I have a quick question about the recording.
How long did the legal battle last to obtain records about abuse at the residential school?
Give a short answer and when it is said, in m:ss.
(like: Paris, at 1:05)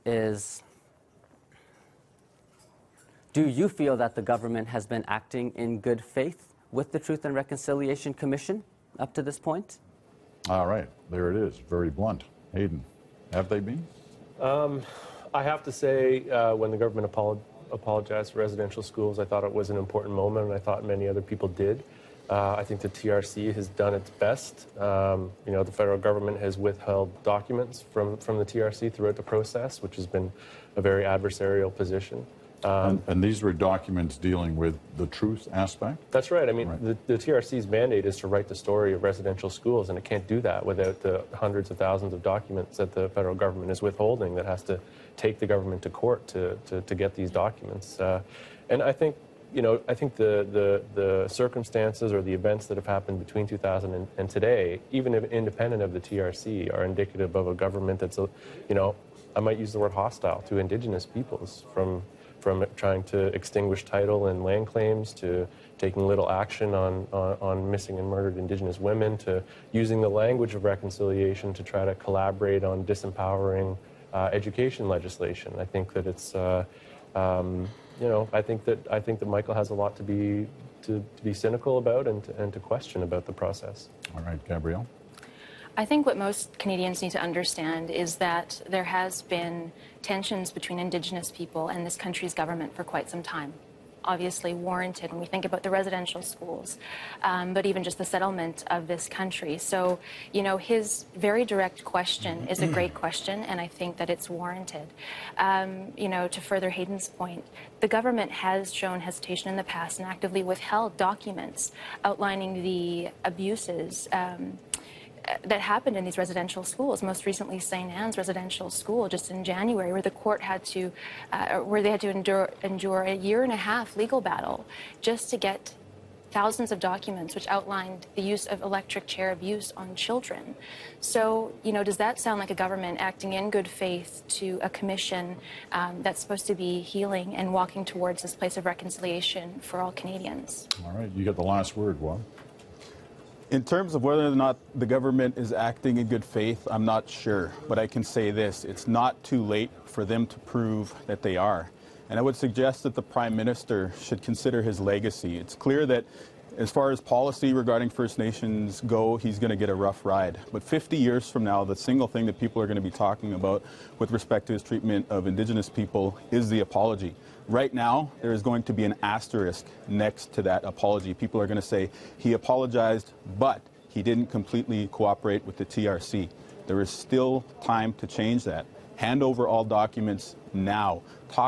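a year and a half, at 2:03.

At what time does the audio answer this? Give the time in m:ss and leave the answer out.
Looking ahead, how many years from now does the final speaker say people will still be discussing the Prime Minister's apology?
2:40.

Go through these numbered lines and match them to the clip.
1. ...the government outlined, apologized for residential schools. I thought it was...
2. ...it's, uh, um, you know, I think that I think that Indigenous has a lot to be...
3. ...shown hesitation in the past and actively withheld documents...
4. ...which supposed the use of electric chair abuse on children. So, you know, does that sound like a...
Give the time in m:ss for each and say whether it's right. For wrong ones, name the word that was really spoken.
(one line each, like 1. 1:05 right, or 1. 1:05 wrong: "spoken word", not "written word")
1. 0:16 wrong: "apologized", not "outlined"
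2. 1:16 wrong: "Michael", not "Indigenous"
3. 1:48 right
4. 2:07 wrong: "outlined", not "supposed".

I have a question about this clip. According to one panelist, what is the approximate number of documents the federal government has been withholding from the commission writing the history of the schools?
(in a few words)
hundreds of thousands.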